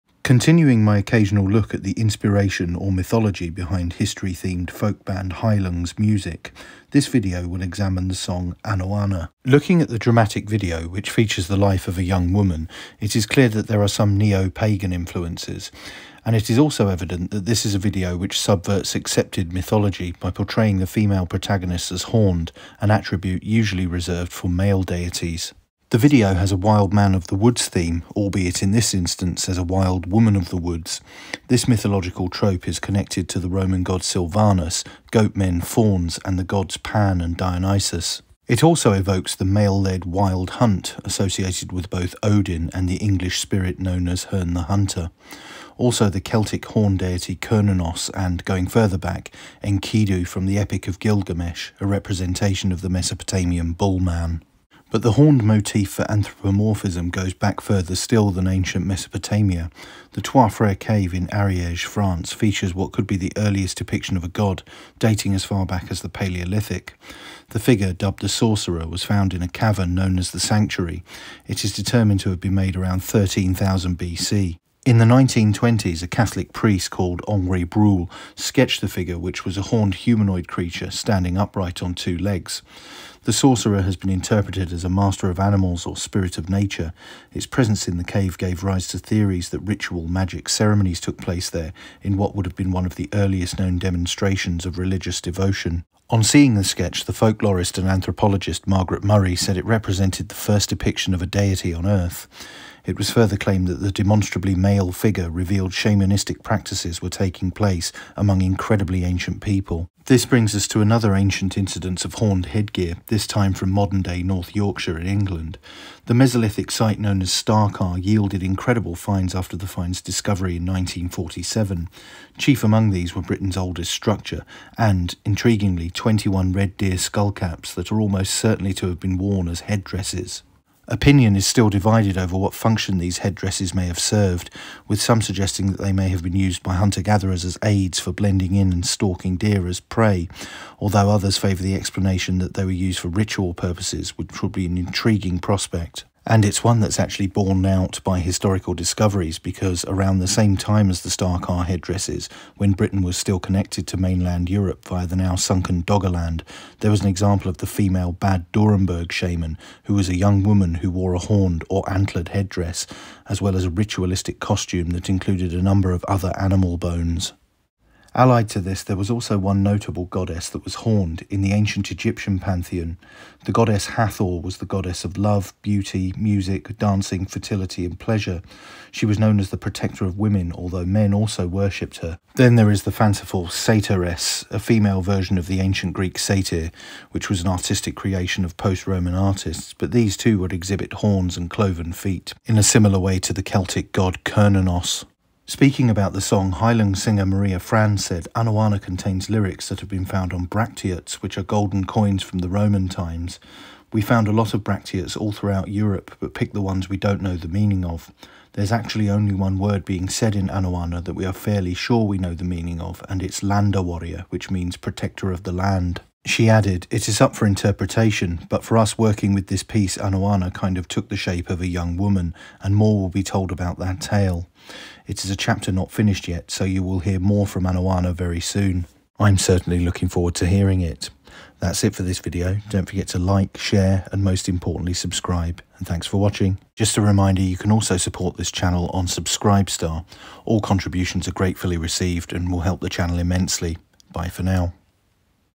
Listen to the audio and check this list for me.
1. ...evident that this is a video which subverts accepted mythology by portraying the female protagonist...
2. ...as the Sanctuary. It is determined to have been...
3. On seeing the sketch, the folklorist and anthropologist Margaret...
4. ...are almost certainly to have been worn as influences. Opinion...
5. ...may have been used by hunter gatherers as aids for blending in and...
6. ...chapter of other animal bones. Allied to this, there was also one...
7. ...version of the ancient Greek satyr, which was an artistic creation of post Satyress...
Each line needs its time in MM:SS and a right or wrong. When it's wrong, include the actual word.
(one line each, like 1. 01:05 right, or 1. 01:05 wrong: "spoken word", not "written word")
1. 00:16 right
2. 01:10 right
3. 01:36 right
4. 02:07 wrong: "headdresses", not "influences"
5. 02:15 right
6. 02:45 wrong: "number", not "chapter"
7. 03:05 wrong: "Roman", not "Satyress".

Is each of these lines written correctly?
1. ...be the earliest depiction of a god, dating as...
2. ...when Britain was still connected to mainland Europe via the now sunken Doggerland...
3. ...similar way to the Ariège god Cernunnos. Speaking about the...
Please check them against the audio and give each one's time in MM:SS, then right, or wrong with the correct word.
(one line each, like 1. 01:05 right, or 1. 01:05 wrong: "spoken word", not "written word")
1. 01:03 right
2. 02:32 right
3. 03:12 wrong: "Celtic", not "Ariège".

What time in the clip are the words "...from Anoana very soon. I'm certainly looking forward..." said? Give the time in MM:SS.
03:47.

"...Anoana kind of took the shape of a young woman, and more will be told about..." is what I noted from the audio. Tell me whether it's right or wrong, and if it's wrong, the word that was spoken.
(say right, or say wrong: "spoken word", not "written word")
right.